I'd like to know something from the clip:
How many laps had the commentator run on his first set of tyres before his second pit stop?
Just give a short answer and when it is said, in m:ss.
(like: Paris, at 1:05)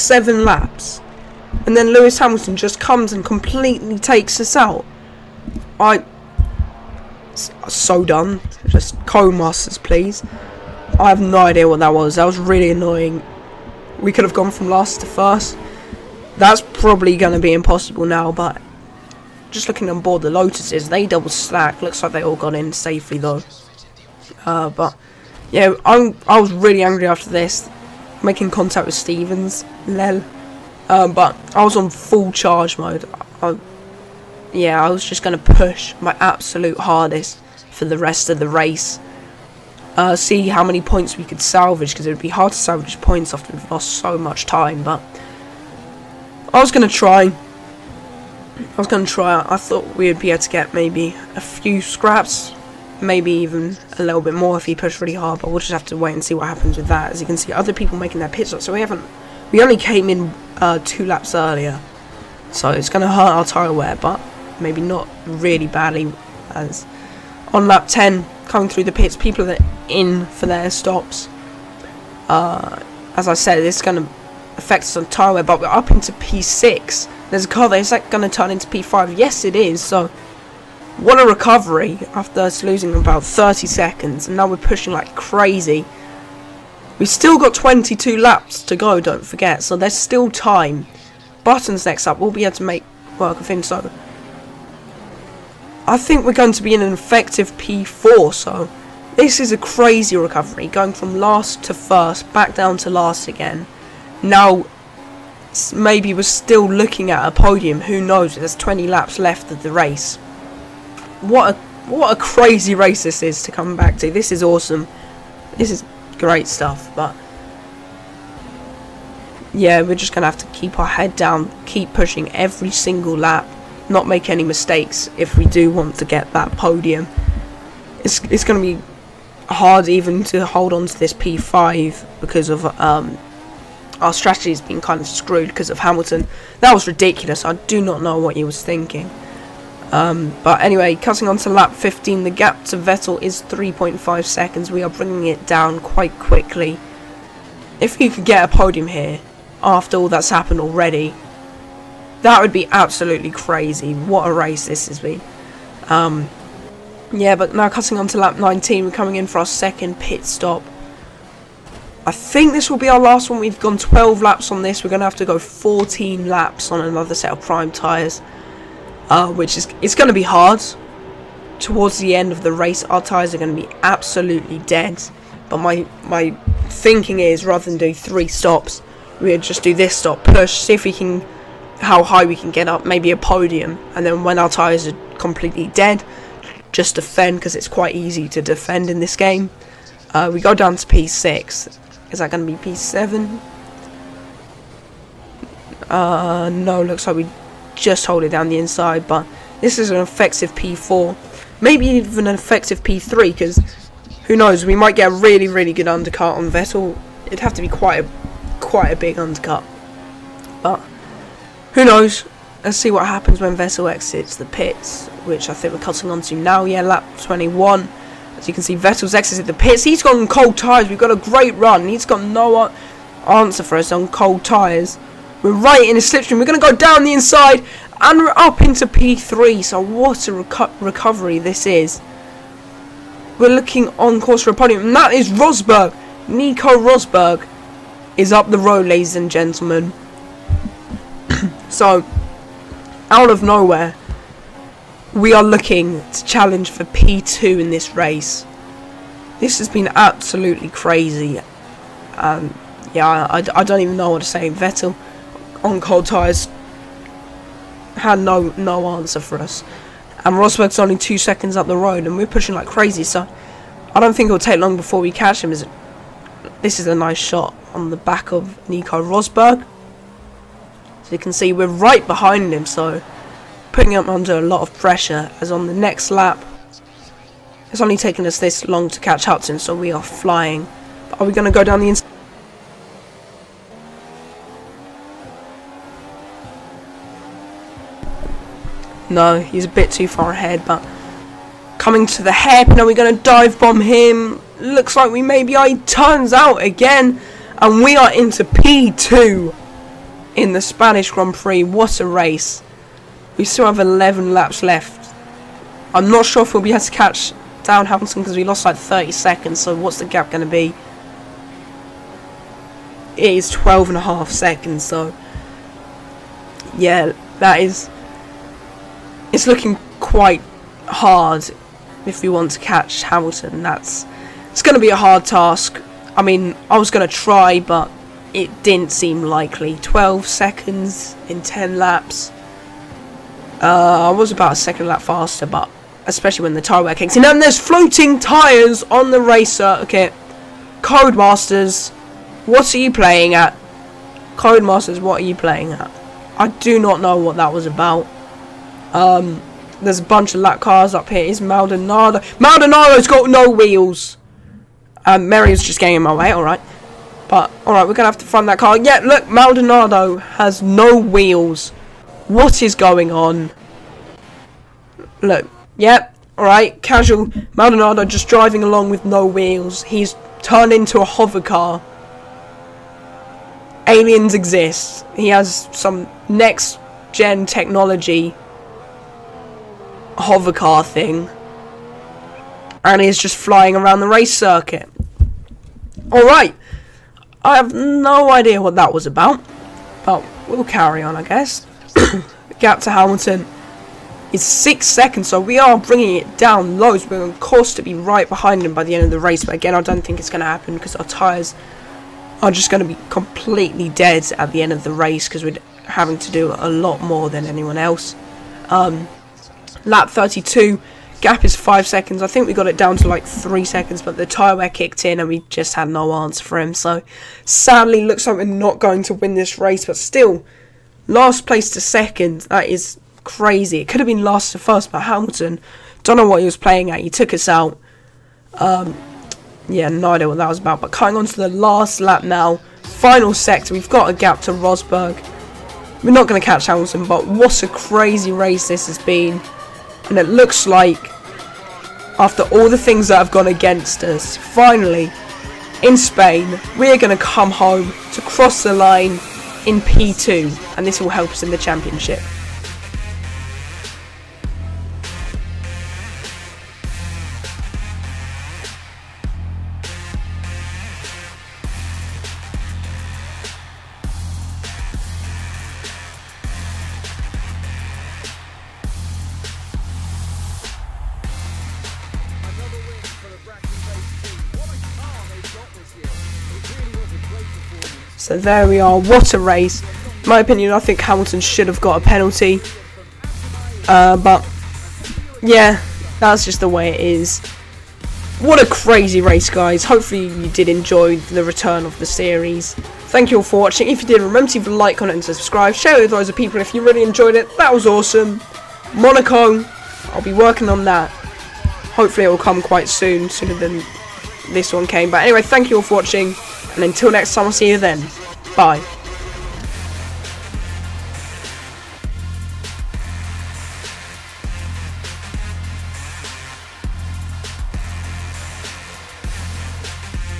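12, at 2:43.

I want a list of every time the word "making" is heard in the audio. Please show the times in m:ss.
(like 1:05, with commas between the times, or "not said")
0:28, 0:57.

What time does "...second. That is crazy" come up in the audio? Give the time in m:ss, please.
7:01.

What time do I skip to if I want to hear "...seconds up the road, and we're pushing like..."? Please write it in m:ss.
4:21.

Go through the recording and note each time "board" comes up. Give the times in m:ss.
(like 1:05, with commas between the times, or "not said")
0:20.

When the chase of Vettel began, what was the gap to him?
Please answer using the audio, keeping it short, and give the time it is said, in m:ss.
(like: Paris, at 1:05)
3.5 seconds, at 2:23.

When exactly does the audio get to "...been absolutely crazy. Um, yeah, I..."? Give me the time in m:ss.
4:09.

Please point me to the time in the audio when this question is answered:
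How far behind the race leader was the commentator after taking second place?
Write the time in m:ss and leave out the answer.
5:13.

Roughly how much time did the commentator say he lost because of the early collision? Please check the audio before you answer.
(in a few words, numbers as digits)
30 seconds.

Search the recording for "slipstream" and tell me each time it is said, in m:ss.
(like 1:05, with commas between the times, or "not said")
3:46.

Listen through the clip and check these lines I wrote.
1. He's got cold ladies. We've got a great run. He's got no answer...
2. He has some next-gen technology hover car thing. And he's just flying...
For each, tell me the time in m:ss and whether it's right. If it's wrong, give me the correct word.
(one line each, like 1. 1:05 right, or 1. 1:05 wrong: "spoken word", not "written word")
1. 3:39 wrong: "tyres", not "ladies"
2. 6:15 right.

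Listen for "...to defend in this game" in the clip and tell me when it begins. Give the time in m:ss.
3:08.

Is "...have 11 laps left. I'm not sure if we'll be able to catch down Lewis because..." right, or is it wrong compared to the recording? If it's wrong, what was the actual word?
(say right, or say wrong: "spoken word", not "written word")
wrong: "Hamilton", not "Lewis".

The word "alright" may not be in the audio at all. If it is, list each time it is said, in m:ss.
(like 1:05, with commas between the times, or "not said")
5:57, 6:06, 6:26.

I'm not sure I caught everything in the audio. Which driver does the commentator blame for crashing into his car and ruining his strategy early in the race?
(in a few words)
Lewis Hamilton.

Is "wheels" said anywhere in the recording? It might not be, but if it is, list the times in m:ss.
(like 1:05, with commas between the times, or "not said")
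5:53, 6:00, 6:09.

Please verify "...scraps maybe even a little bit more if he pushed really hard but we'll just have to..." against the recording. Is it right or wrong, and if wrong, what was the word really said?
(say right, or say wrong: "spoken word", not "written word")
right.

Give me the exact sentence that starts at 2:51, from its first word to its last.
Towards the end of the race, our tyres are going to be absolutely dead.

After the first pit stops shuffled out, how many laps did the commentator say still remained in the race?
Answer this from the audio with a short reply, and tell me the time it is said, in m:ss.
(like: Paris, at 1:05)
22, at 1:27.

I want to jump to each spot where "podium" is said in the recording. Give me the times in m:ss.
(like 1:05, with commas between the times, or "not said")
1:47, 2:06, 2:28, 3:03, 3:54.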